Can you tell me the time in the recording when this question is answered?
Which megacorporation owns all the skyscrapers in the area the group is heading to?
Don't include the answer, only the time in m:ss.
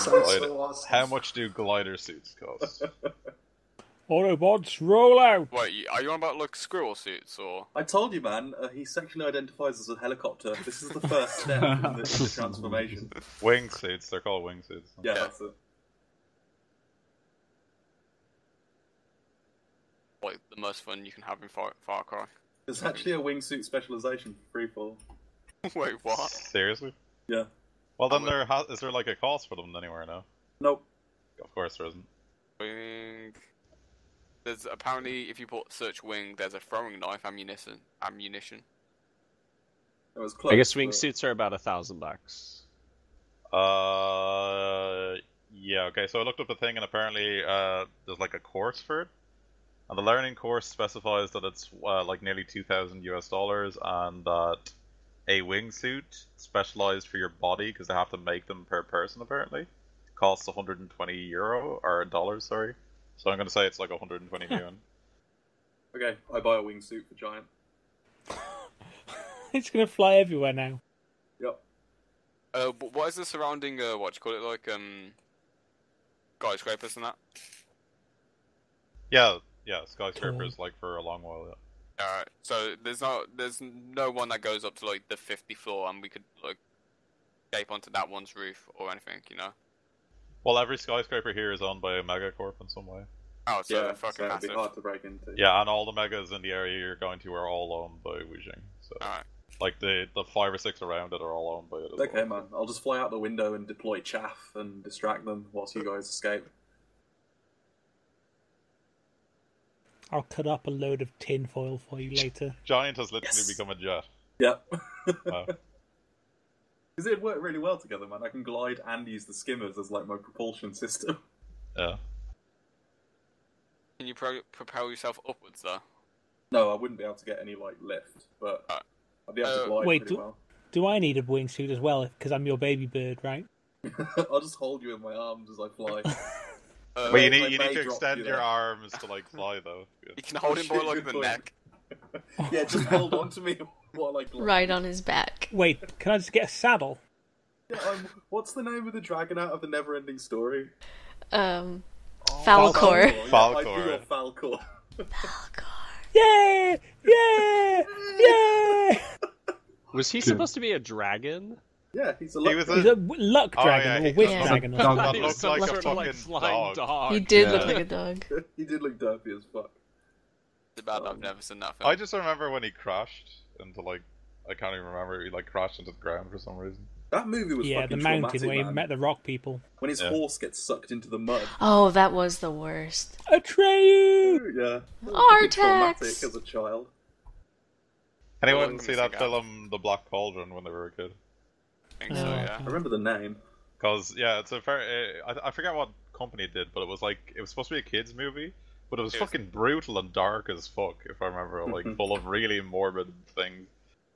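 1:38.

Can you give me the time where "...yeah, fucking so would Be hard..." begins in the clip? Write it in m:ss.
1:33.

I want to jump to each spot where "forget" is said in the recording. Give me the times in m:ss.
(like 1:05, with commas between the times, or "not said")
3:15.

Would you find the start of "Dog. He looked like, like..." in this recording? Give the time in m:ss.
2:44.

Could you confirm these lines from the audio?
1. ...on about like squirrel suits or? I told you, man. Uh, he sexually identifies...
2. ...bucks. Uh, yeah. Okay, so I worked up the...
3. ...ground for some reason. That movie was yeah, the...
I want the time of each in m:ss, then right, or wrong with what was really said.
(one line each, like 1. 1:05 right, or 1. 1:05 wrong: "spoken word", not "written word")
1. 0:06 right
2. 0:41 wrong: "looked", not "worked"
3. 2:55 right.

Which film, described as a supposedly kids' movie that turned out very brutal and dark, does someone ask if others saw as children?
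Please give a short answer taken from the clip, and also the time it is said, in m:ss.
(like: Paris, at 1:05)
The Black Cauldron, at 3:09.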